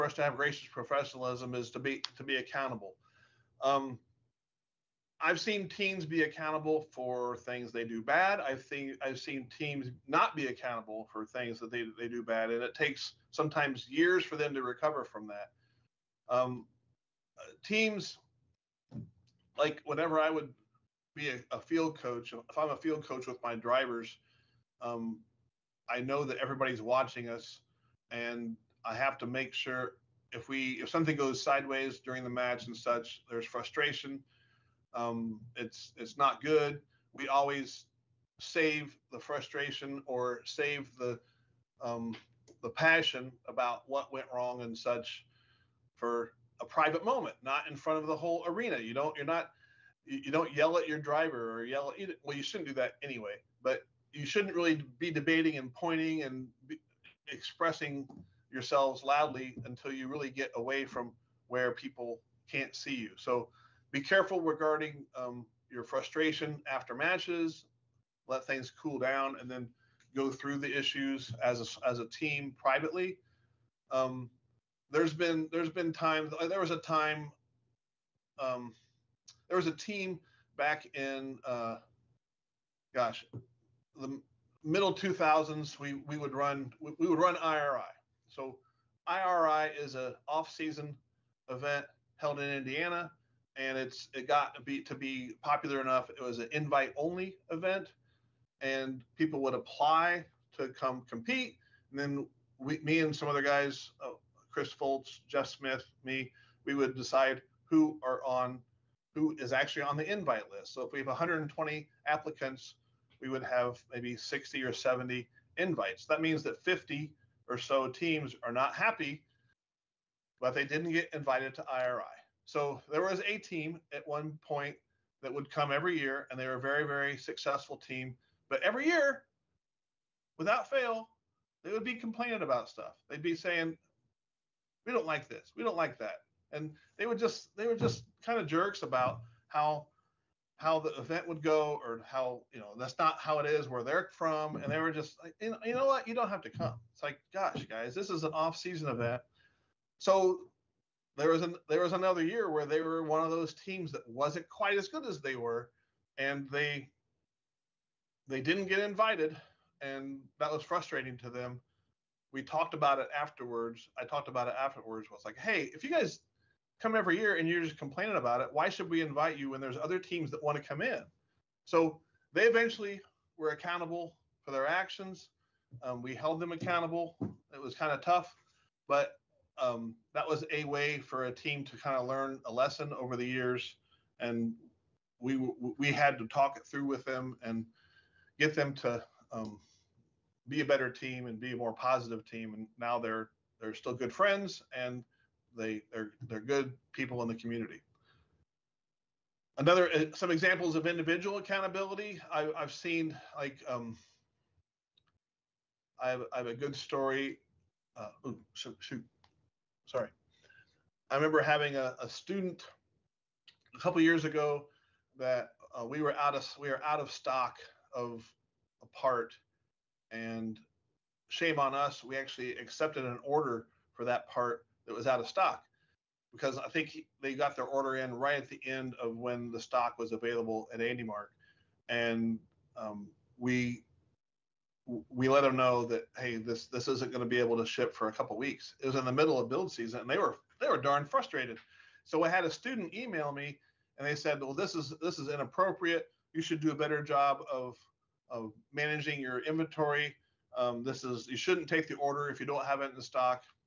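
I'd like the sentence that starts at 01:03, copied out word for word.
So be careful regarding um, your frustration after matches.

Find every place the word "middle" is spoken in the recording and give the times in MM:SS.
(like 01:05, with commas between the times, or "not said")
01:24, 03:59.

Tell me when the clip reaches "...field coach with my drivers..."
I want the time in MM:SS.
00:22.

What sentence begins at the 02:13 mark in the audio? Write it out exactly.
They'd be saying, "We don't like this.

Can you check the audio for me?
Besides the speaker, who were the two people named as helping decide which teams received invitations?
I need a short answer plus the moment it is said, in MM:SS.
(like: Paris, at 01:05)
Chris Fultz, Jeff Smith, at 01:44.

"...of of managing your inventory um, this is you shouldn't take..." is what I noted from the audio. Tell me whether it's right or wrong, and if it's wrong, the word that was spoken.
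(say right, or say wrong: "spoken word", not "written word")
right.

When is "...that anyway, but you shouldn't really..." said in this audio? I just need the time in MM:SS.
00:52.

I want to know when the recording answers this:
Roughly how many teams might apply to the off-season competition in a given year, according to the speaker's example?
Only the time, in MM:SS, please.
01:51.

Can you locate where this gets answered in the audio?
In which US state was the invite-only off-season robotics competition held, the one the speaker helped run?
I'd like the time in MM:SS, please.
01:32.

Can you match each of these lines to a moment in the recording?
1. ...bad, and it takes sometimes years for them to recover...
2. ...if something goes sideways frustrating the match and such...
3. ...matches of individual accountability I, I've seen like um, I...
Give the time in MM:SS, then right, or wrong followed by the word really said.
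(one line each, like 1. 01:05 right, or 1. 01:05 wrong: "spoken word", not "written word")
1. 00:12 right
2. 00:30 wrong: "during", not "frustrating"
3. 03:20 wrong: "examples", not "matches".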